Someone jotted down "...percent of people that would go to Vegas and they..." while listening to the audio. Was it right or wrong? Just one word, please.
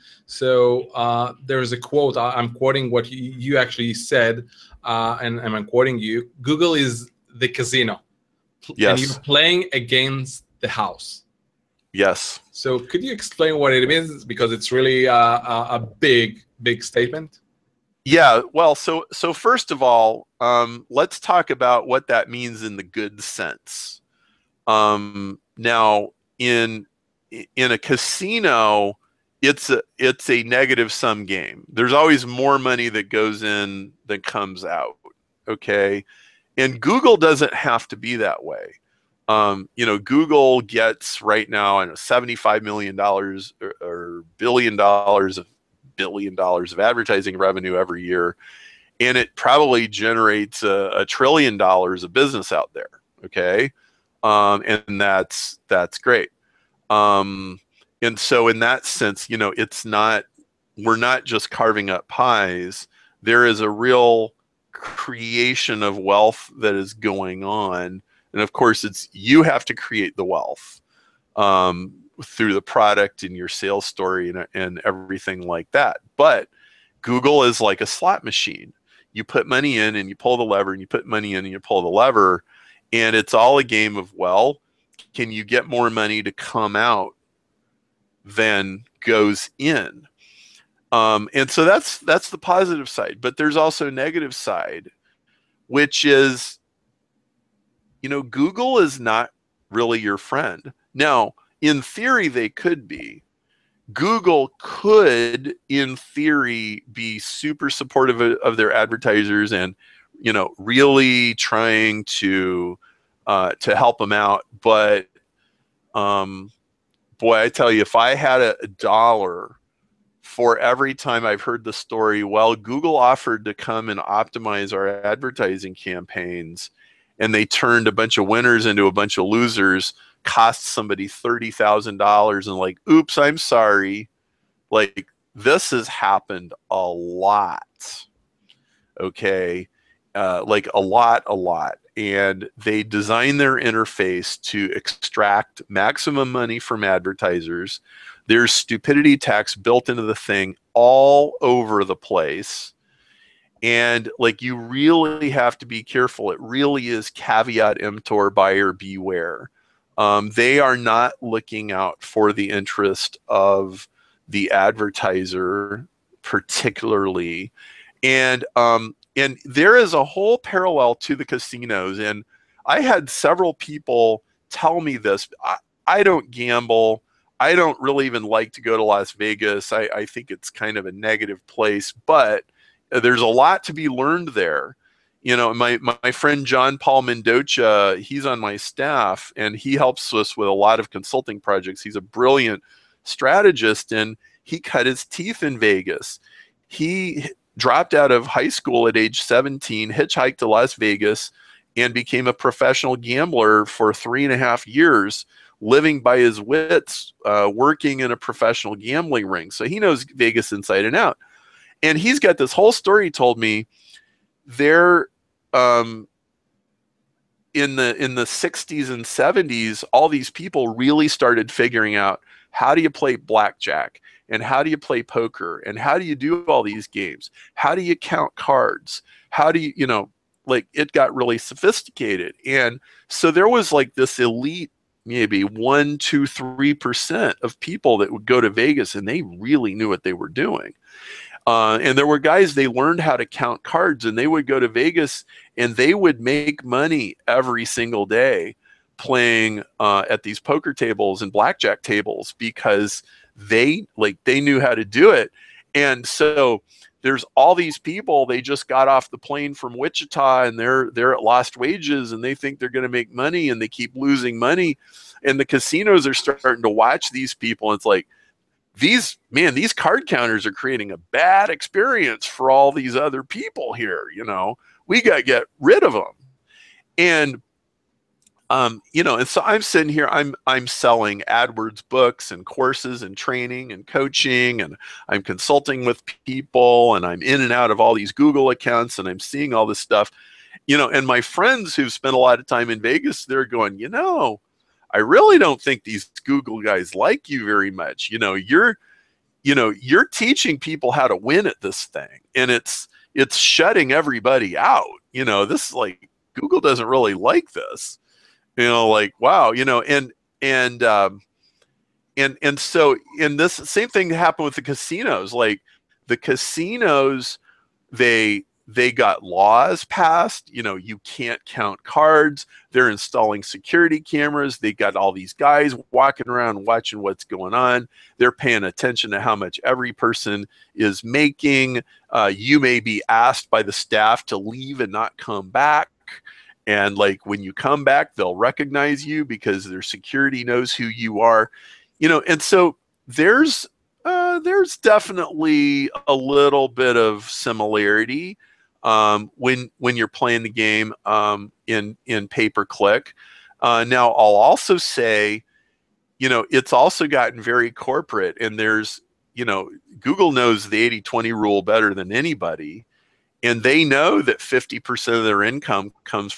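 right.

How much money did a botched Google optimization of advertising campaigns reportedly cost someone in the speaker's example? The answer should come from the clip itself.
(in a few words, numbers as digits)
$30,000.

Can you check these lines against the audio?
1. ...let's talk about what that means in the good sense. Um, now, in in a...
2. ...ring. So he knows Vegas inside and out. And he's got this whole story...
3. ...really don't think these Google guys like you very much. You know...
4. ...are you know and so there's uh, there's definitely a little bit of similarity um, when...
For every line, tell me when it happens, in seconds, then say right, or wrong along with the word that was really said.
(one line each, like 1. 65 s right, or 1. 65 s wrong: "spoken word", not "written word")
1. 20 s right
2. 209 s right
3. 294 s right
4. 341 s right.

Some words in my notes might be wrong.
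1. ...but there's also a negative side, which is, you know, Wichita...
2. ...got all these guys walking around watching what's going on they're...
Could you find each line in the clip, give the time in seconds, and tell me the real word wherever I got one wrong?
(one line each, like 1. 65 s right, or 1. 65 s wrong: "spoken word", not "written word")
1. 93 s wrong: "Google", not "Wichita"
2. 324 s right.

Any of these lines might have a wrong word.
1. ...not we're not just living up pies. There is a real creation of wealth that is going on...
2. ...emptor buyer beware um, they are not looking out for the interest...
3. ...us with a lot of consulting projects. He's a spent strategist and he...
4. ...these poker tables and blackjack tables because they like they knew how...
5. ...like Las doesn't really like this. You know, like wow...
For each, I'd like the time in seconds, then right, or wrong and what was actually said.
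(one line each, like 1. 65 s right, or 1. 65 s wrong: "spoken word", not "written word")
1. 59 s wrong: "carving", not "living"
2. 157 s right
3. 190 s wrong: "brilliant", not "spent"
4. 250 s right
5. 305 s wrong: "Google", not "Las".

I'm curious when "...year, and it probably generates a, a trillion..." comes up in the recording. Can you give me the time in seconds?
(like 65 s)
48 s.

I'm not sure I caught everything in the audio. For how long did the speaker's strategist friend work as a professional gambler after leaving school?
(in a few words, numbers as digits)
3.5 years.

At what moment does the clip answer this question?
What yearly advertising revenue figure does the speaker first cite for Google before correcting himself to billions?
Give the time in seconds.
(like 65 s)
41 s.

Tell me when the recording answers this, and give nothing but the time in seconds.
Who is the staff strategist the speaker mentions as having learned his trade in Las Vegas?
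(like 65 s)
186 s.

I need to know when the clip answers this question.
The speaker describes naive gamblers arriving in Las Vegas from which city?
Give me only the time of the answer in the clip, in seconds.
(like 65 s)
259 s.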